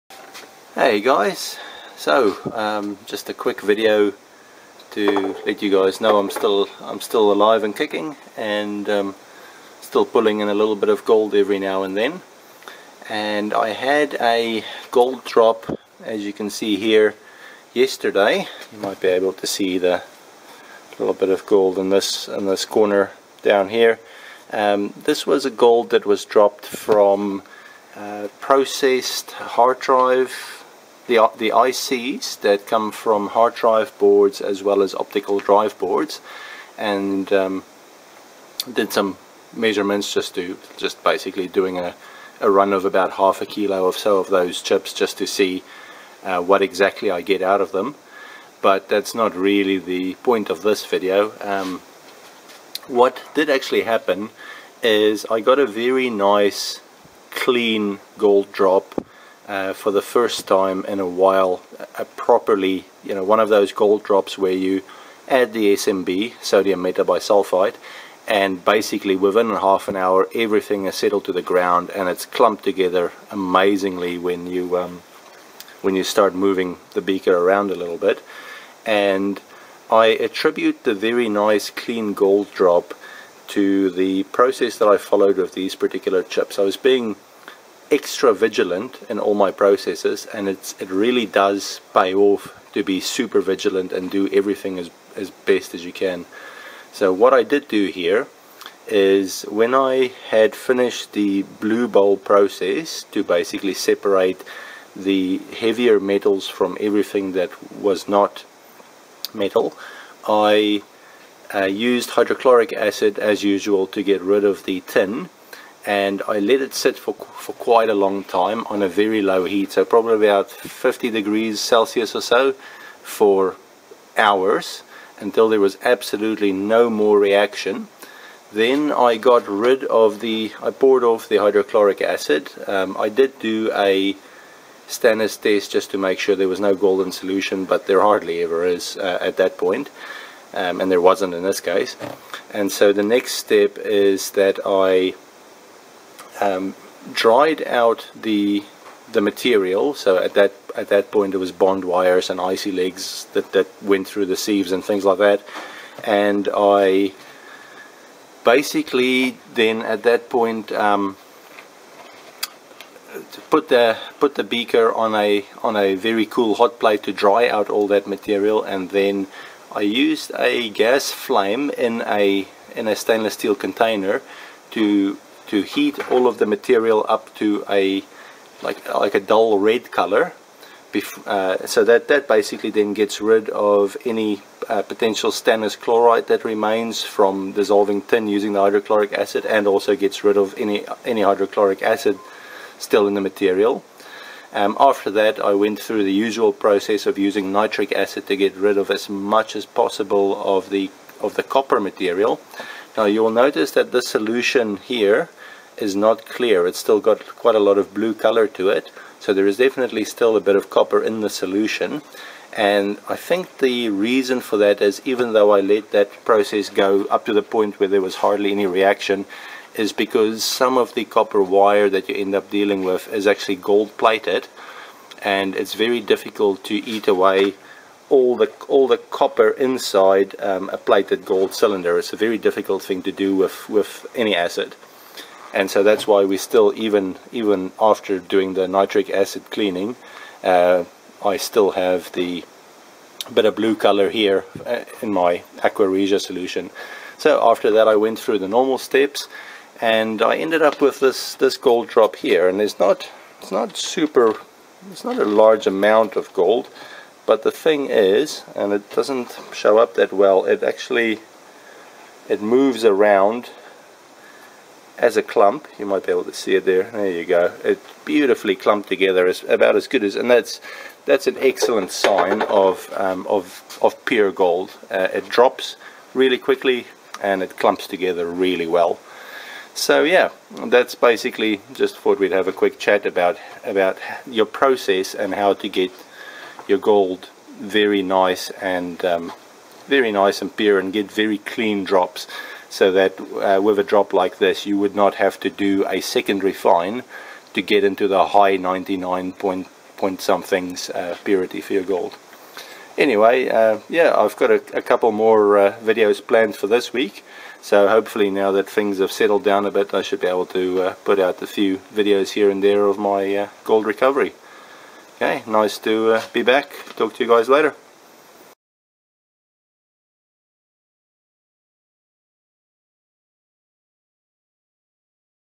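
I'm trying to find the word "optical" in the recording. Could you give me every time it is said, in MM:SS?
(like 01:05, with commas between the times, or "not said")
00:34.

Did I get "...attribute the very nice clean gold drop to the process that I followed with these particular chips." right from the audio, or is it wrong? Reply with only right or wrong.
right.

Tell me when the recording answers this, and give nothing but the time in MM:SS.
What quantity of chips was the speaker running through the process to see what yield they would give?
00:43.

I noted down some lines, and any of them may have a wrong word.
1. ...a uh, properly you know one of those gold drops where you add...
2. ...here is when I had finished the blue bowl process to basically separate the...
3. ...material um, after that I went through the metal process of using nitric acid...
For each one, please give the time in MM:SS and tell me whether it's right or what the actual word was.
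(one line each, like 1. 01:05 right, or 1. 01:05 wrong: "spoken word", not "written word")
1. 01:02 right
2. 01:37 right
3. 03:13 wrong: "usual", not "metal".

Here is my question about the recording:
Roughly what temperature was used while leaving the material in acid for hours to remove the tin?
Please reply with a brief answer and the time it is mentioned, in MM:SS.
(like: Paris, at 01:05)
50 degrees Celsius, at 02:00.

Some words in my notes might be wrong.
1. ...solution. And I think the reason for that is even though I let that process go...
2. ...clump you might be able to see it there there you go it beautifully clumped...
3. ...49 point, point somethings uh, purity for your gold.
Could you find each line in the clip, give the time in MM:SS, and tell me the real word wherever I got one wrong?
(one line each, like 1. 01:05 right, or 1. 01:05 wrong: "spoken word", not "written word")
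1. 03:31 right
2. 04:25 right
3. 04:58 wrong: "99", not "49".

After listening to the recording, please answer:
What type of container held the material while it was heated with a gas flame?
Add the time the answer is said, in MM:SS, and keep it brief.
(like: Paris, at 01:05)
stainless steel container, at 02:52.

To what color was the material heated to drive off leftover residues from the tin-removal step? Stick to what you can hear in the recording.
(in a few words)
dull red.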